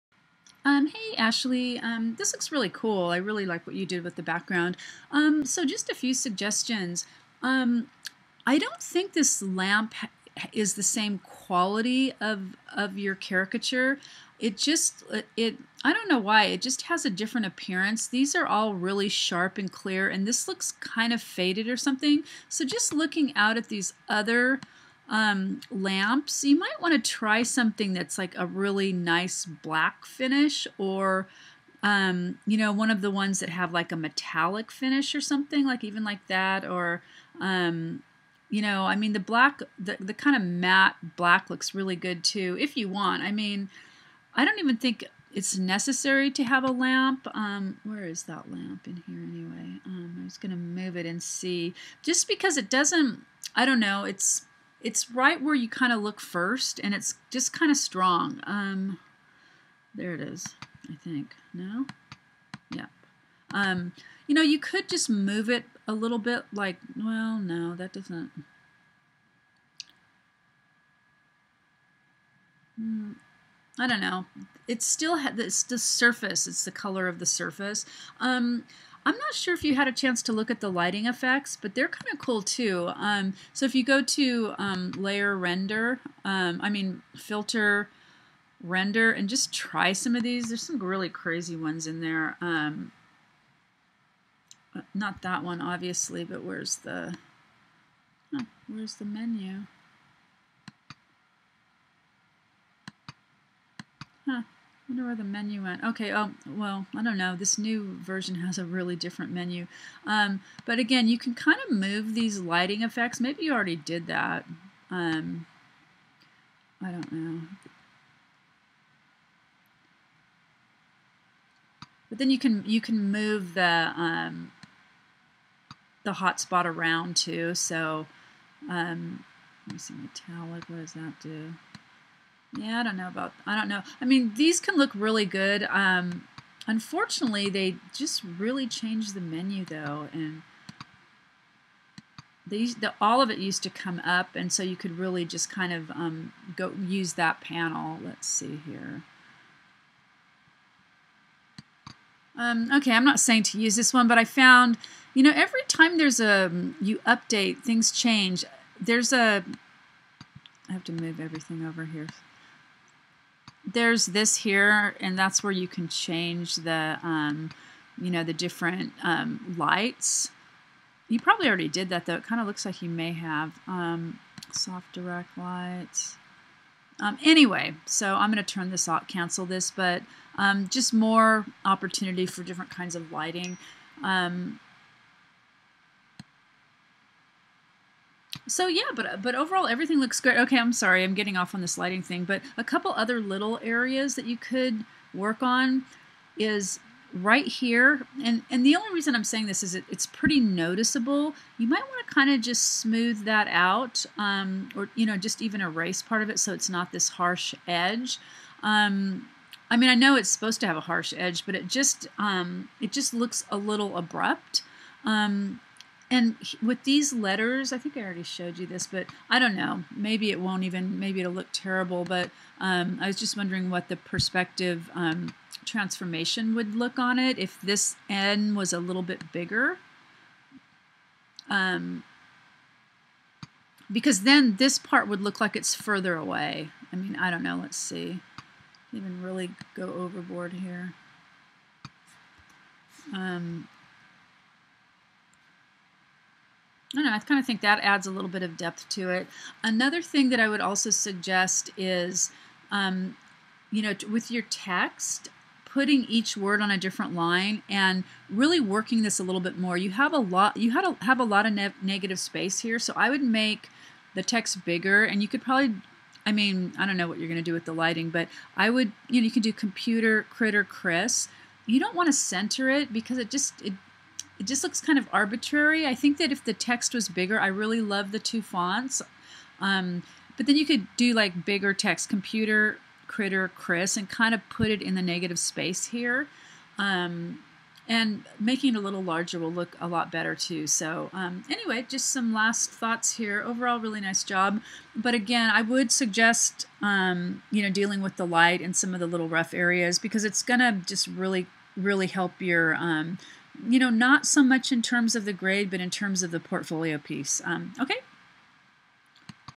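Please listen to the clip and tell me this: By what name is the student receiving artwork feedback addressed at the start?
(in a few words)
Ashley.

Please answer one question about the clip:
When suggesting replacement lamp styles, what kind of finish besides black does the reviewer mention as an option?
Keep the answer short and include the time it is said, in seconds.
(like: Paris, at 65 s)
metallic finish, at 33 s.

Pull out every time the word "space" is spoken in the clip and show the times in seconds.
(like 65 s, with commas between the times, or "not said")
262 s, 285 s.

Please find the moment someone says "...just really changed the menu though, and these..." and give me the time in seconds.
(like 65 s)
137 s.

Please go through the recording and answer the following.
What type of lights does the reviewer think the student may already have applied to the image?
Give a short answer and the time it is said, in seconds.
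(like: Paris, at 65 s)
soft direct lights, at 174 s.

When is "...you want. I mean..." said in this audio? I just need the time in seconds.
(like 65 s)
42 s.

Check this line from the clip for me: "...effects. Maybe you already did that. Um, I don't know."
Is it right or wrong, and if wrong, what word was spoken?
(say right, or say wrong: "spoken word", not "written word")
right.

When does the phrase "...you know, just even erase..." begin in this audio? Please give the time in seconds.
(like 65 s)
204 s.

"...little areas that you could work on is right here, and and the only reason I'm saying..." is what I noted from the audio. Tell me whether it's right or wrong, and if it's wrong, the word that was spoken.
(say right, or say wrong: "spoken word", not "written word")
right.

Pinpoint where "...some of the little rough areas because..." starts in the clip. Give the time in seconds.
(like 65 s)
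298 s.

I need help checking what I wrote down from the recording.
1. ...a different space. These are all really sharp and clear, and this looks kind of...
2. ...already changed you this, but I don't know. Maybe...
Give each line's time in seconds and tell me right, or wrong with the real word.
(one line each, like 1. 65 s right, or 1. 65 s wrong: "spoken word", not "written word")
1. 17 s wrong: "appearance", not "space"
2. 218 s wrong: "showed", not "changed".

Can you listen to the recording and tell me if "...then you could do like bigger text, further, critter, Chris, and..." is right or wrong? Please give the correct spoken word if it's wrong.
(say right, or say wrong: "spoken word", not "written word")
wrong: "computer", not "further".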